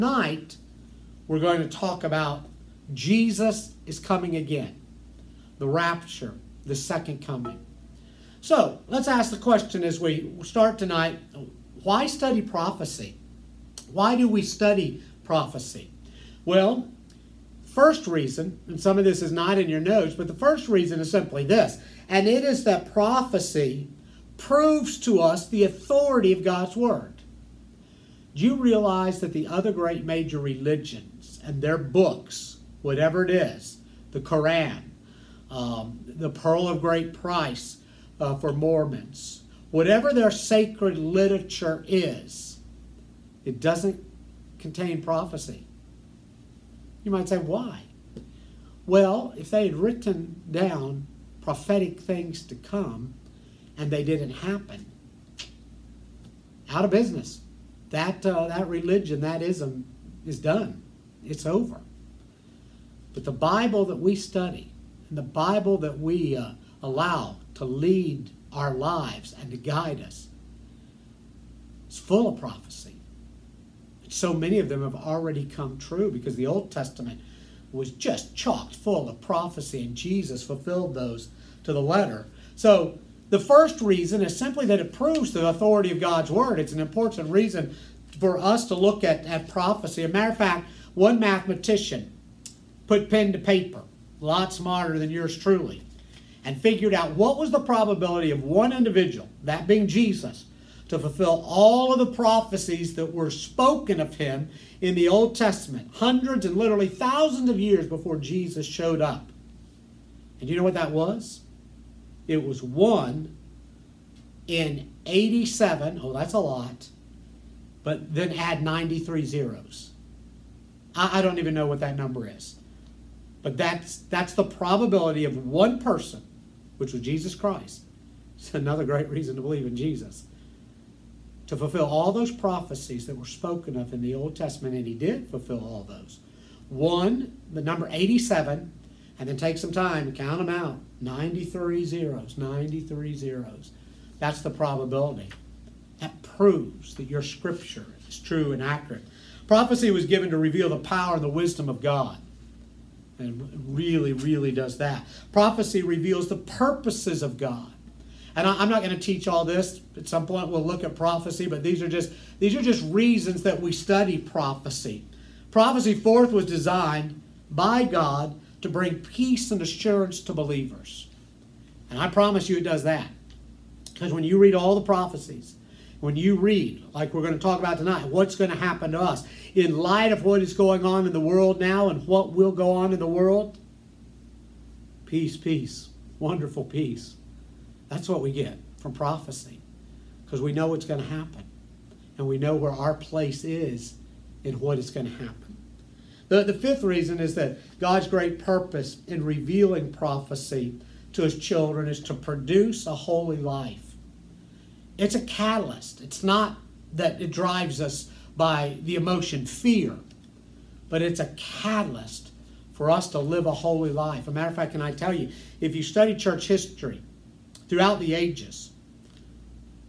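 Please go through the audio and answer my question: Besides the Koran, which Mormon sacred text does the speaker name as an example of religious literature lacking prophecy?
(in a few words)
Pearl of Great Price.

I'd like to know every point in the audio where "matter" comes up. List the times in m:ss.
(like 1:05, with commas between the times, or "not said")
1:30, 3:34.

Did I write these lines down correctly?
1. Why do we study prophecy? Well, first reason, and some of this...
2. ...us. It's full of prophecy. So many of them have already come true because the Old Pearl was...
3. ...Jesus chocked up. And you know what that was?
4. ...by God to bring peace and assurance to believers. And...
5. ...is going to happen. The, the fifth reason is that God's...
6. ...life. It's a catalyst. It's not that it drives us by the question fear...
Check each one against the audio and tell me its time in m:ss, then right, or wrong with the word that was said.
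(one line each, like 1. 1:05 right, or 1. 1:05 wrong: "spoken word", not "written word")
1. 0:13 right
2. 1:10 wrong: "Testament", not "Pearl"
3. 1:48 wrong: "showed", not "chocked"
4. 2:47 right
5. 3:14 right
6. 3:23 wrong: "emotion", not "question".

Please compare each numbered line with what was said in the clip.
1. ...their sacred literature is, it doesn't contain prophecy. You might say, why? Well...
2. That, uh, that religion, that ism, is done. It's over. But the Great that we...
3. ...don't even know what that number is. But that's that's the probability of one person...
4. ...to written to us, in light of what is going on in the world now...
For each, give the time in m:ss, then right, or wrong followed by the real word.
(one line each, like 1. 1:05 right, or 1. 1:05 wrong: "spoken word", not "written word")
1. 0:40 right
2. 0:57 wrong: "Bible", not "Great"
3. 2:01 right
4. 2:58 wrong: "happen", not "written".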